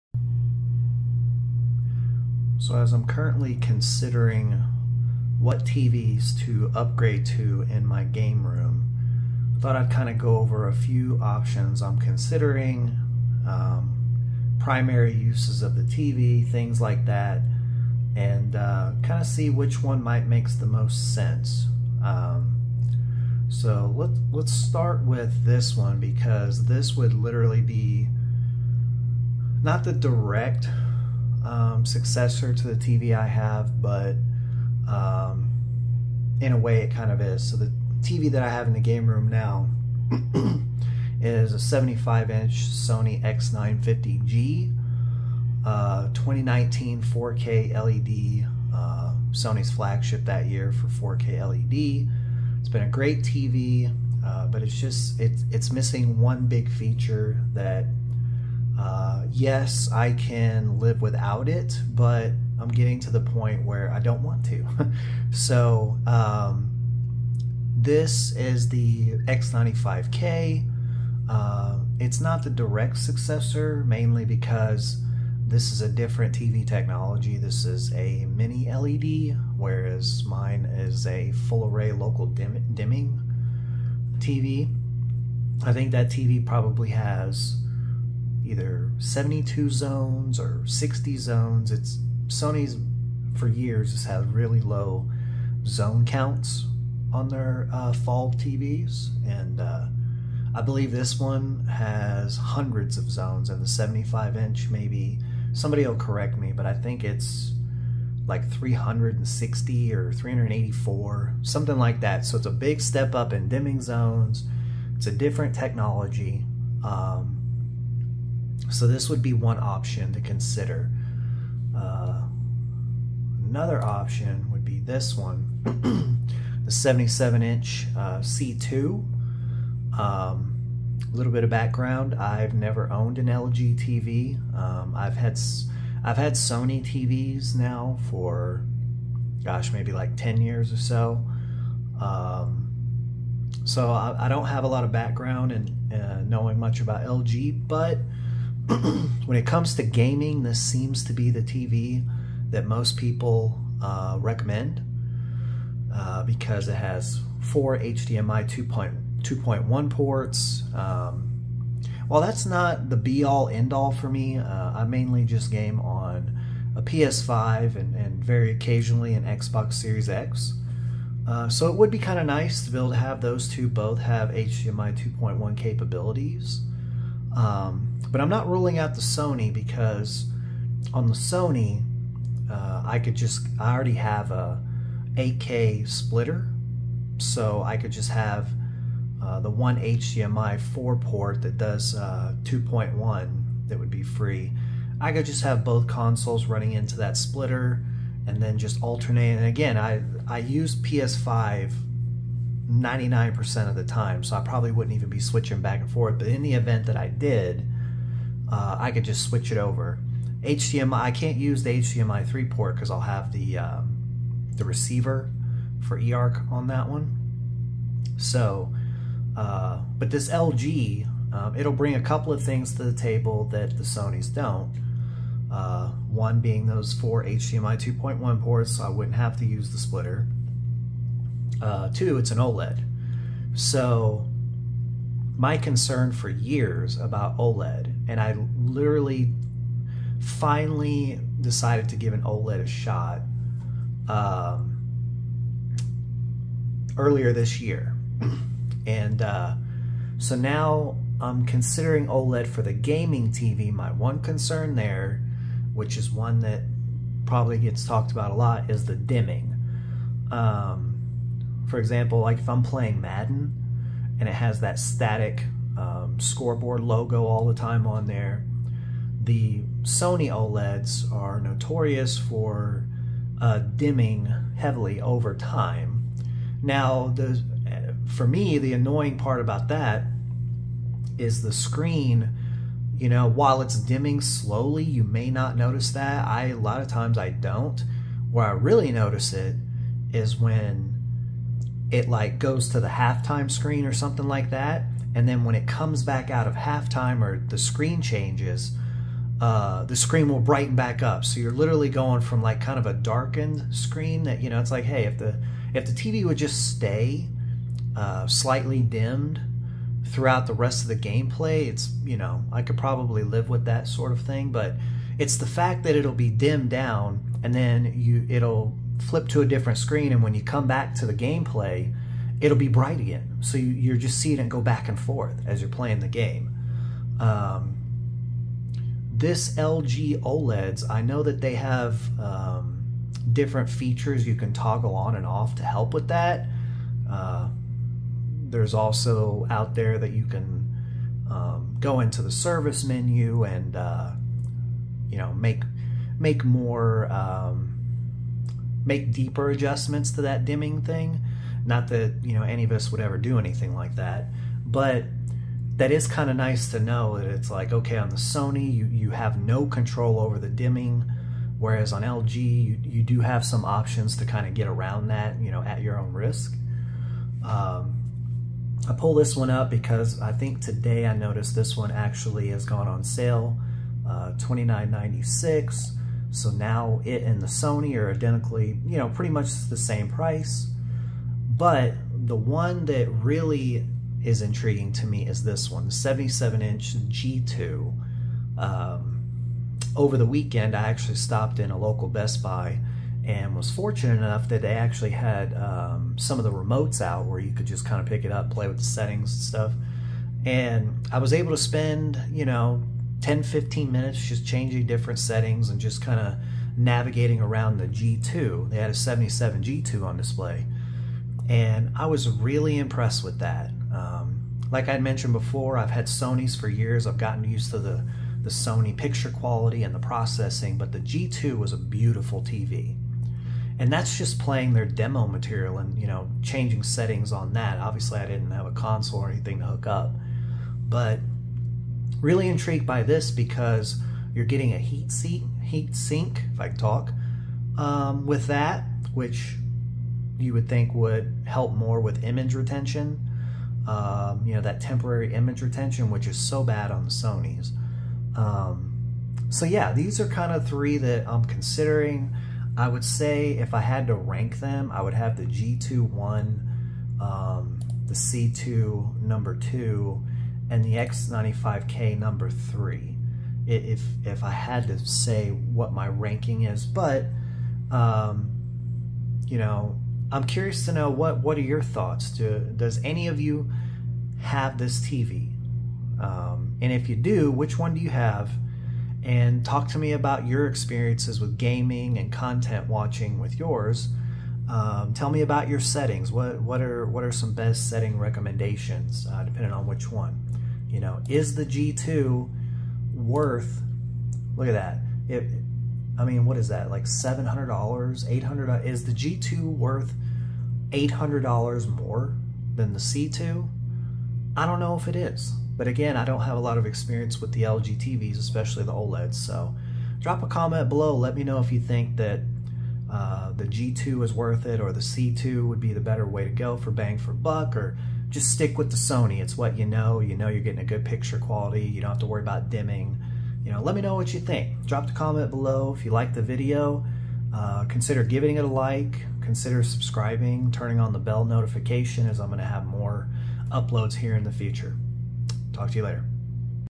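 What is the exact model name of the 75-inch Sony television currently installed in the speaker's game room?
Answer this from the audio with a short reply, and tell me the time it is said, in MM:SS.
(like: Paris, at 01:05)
X950G, at 00:43.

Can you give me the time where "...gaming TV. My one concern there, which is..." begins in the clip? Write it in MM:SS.
04:12.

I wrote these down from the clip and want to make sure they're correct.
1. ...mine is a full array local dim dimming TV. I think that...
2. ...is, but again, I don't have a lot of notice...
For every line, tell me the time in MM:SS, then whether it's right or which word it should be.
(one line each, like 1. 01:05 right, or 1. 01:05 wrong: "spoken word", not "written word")
1. 01:20 right
2. 08:25 wrong: "experience", not "notice".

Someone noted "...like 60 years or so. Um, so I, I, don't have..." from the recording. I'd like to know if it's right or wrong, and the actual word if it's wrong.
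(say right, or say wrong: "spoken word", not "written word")
wrong: "10", not "60".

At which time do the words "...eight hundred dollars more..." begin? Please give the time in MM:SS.
08:20.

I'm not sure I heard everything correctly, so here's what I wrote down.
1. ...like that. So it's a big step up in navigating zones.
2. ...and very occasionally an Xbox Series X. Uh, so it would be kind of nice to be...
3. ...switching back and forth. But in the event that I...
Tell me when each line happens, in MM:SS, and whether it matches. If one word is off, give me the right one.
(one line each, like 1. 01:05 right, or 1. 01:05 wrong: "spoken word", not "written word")
1. 01:51 wrong: "dimming", not "navigating"
2. 02:47 right
3. 03:25 right.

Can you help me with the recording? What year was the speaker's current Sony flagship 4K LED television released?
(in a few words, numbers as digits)
2019.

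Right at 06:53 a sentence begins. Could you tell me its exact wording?
Um, like I mentioned before, I've had Sony's for years.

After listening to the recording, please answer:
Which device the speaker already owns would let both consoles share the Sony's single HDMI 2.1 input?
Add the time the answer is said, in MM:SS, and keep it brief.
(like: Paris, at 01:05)
8K splitter, at 03:05.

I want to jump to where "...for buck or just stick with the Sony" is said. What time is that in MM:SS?
08:37.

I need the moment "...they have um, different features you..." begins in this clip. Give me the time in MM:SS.
05:31.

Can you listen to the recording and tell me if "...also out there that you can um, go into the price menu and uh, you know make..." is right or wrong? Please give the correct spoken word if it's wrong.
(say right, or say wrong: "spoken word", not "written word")
wrong: "service", not "price".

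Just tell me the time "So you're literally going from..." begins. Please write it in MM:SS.
05:01.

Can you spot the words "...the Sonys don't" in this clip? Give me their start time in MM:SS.
03:43.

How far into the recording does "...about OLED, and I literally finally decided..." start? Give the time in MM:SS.
03:56.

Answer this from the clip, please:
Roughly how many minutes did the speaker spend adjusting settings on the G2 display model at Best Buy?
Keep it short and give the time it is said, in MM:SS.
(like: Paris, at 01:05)
10 to 15 minutes, at 06:43.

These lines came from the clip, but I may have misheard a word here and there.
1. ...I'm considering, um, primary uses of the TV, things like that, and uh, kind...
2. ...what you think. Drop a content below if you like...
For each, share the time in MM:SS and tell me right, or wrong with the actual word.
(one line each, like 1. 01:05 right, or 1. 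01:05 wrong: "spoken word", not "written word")
1. 00:11 right
2. 08:44 wrong: "comment", not "content".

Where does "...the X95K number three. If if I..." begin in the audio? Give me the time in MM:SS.
07:40.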